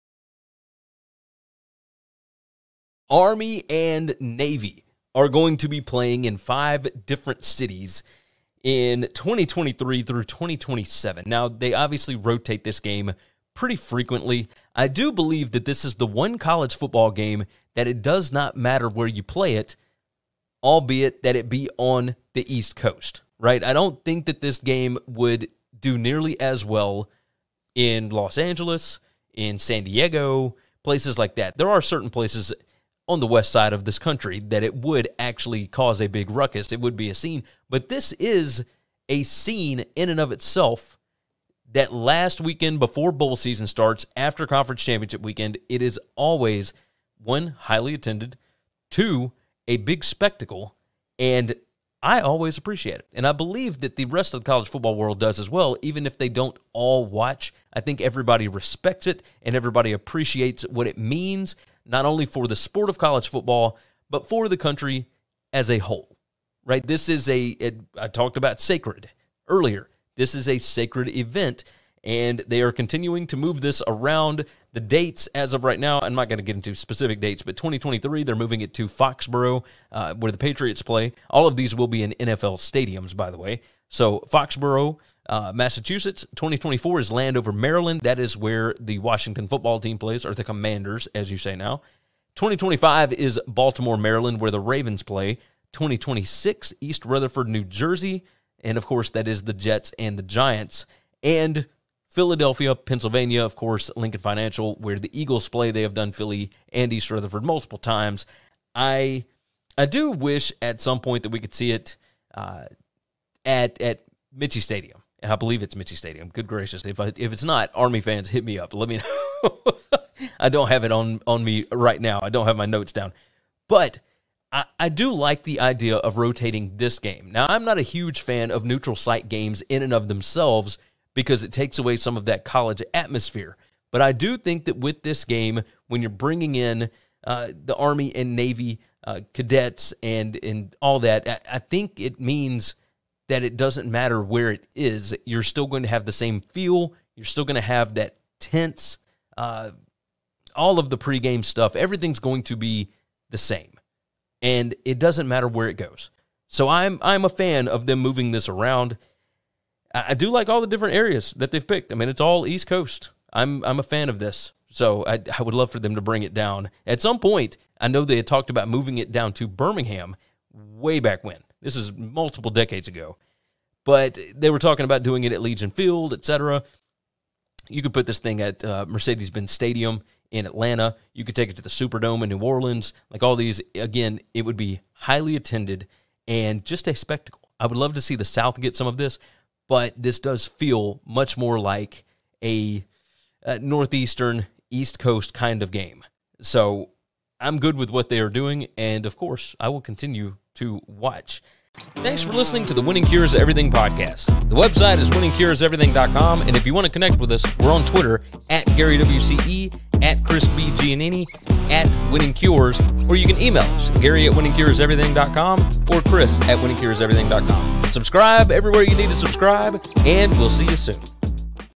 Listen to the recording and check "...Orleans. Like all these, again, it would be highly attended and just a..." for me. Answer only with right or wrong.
right.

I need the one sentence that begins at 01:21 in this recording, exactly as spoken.
All of these will be in NFL stadiums, by the way.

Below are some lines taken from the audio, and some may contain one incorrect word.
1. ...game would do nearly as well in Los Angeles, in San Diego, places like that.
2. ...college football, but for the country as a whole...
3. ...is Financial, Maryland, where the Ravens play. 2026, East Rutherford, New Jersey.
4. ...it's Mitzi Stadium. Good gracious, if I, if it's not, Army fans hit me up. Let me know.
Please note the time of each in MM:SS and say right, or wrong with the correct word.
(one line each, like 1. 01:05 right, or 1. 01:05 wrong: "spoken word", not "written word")
1. 00:24 right
2. 01:02 right
3. 01:33 wrong: "Baltimore", not "Financial"
4. 01:55 right.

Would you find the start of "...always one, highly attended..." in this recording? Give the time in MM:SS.
00:46.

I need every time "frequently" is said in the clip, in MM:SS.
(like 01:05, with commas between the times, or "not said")
00:13.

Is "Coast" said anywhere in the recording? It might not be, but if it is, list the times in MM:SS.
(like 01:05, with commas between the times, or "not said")
00:22, 02:42, 03:14.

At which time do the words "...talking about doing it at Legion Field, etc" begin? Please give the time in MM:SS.
02:54.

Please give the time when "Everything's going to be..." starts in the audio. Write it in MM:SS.
02:31.